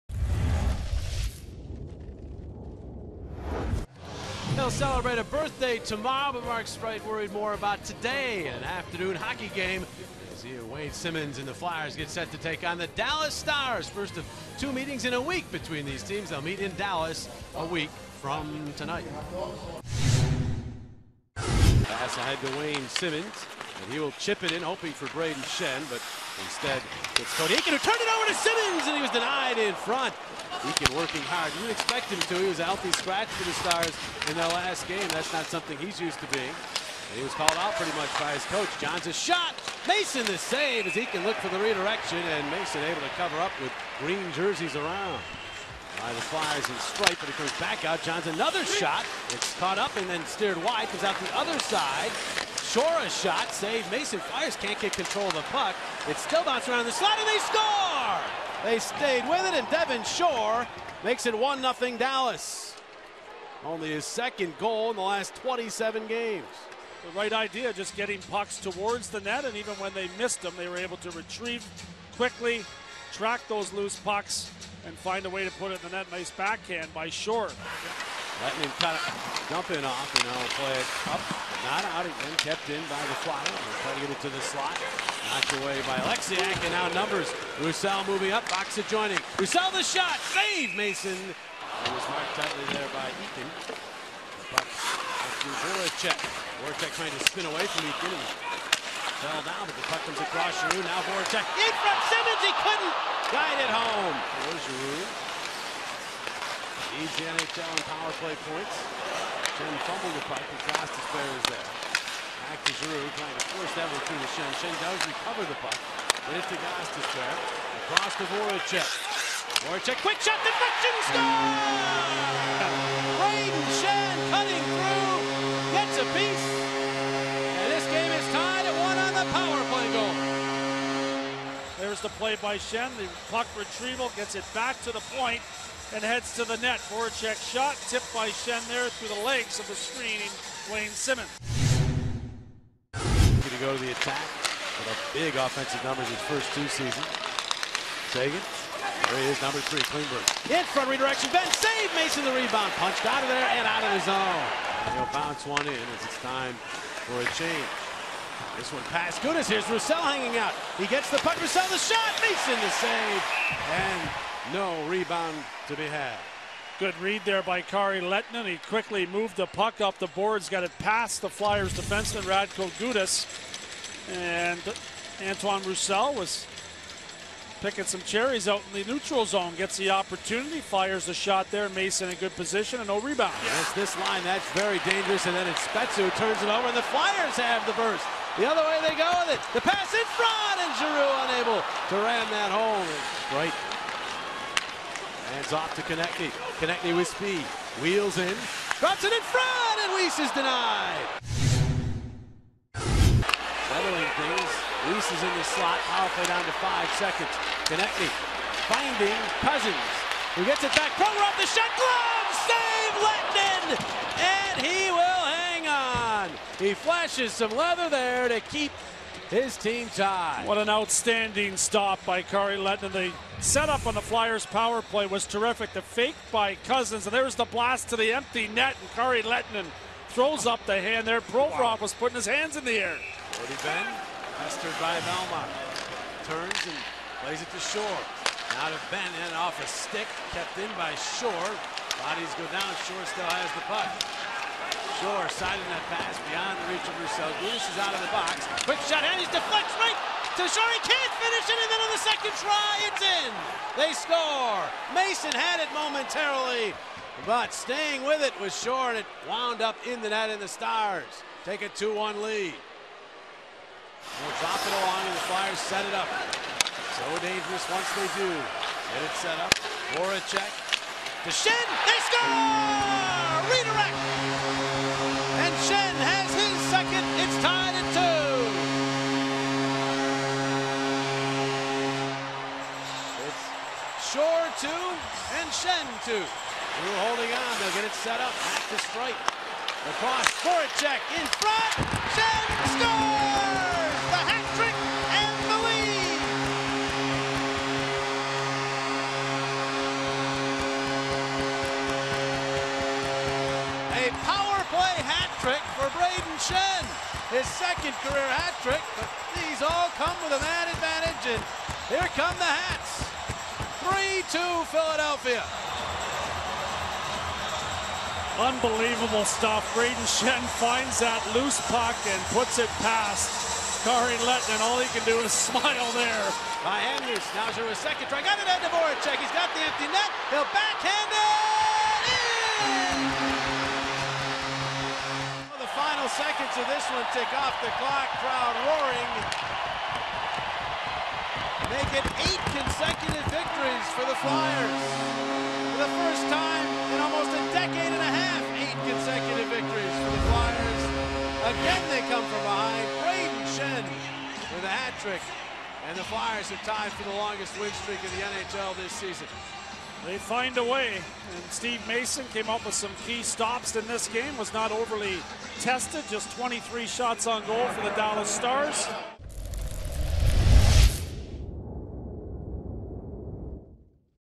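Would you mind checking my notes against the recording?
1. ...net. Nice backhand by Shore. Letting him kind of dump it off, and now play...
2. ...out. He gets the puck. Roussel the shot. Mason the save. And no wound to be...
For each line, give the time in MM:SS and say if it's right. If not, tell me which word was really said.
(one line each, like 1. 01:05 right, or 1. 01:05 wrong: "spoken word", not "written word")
1. 01:15 right
2. 02:40 wrong: "rebound", not "wound".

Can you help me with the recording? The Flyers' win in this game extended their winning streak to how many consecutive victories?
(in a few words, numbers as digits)
8.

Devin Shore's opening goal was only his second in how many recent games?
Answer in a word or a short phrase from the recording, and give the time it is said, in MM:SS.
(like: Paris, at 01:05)
27, at 01:05.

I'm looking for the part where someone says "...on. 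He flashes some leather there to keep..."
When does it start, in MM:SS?
03:35.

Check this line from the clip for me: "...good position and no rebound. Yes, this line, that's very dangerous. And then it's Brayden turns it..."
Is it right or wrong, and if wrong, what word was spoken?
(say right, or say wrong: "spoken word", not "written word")
wrong: "Spezza", not "Brayden".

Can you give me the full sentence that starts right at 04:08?
Quick shot, and he deflects right to Shore.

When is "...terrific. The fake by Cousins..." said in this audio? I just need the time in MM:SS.
03:45.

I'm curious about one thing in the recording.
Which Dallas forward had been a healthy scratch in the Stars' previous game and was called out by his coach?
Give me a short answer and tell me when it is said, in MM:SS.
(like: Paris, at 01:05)
Cody Eakin, at 00:27.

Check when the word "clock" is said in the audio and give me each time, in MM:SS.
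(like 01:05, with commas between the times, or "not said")
05:37.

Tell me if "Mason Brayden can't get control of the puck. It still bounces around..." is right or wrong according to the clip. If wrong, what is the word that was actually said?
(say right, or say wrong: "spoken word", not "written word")
wrong: "Fires", not "Brayden".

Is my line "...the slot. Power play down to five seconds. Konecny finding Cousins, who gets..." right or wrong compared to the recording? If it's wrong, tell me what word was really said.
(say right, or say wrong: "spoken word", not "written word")
right.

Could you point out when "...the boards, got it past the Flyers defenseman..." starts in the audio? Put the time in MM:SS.
02:49.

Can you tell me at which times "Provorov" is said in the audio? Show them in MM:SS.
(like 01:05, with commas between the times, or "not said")
03:51.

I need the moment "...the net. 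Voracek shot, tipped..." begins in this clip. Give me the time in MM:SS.
02:16.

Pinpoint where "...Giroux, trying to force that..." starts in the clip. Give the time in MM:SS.
01:52.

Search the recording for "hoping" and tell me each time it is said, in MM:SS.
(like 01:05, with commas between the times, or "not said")
00:24.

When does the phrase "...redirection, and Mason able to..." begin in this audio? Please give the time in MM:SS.
00:41.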